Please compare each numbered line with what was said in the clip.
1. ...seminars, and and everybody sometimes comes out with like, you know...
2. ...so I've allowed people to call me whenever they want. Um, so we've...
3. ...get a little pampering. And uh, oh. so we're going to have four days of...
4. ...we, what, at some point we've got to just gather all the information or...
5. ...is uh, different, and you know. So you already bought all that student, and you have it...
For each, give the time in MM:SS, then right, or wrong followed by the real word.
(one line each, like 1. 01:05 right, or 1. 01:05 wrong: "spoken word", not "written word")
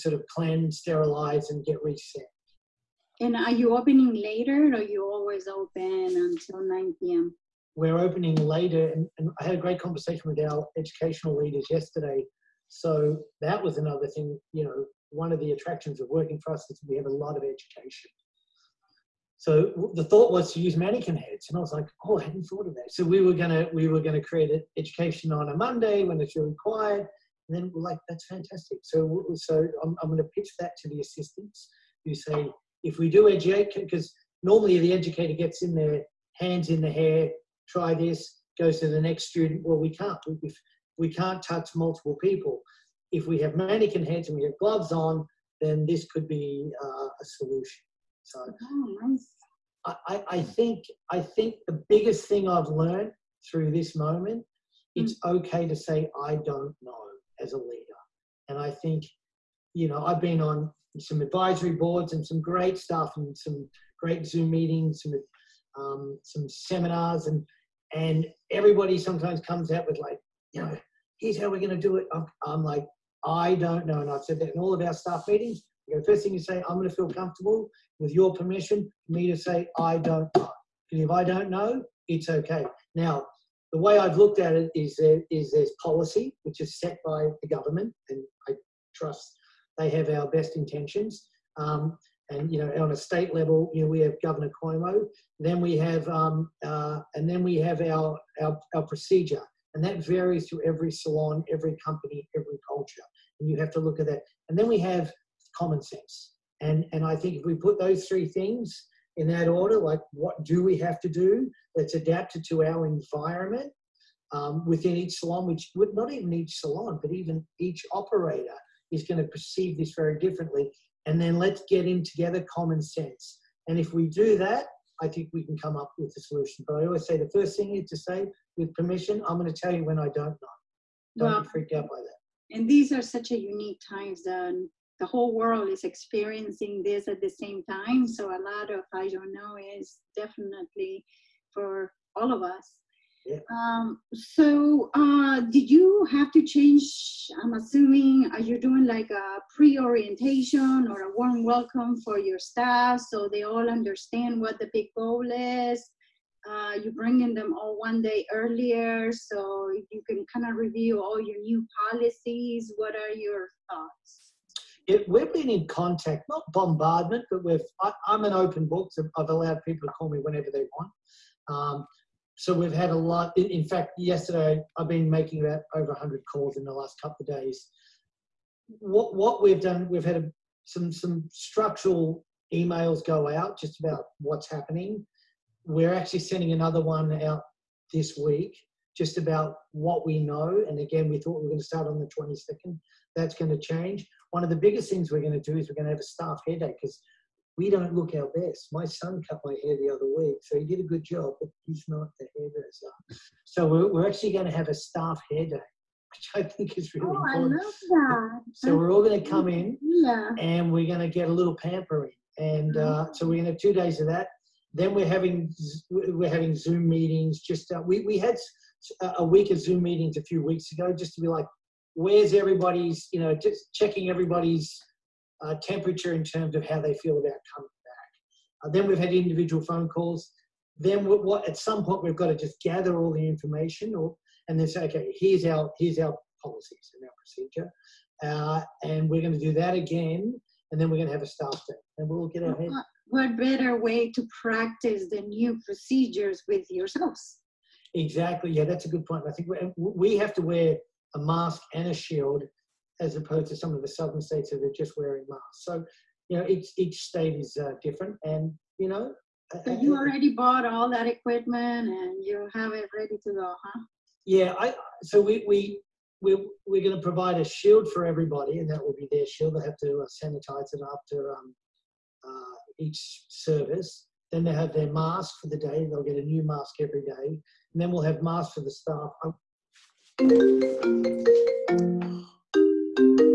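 1. 01:06 right
2. 02:48 right
3. 03:31 wrong: "two", not "four"
4. 03:51 right
5. 04:17 wrong: "equipment", not "student".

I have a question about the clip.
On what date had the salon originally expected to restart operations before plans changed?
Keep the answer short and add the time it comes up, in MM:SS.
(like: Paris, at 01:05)
The 22nd, at 03:11.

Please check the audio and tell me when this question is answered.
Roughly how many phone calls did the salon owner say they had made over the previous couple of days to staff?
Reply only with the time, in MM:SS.
02:55.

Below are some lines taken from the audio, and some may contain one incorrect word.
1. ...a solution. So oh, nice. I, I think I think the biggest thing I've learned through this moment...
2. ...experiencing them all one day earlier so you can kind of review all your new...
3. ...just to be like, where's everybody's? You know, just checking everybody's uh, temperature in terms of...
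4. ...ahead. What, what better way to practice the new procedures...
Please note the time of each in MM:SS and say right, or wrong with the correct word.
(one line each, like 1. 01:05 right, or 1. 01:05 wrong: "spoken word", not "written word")
1. 00:47 right
2. 02:36 wrong: "bringing", not "experiencing"
3. 03:40 right
4. 04:02 right.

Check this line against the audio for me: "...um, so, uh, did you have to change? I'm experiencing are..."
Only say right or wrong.
wrong.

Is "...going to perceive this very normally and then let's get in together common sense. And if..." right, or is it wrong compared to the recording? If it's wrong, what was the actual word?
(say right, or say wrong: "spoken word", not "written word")
wrong: "differently", not "normally".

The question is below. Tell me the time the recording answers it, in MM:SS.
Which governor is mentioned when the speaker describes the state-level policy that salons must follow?
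01:34.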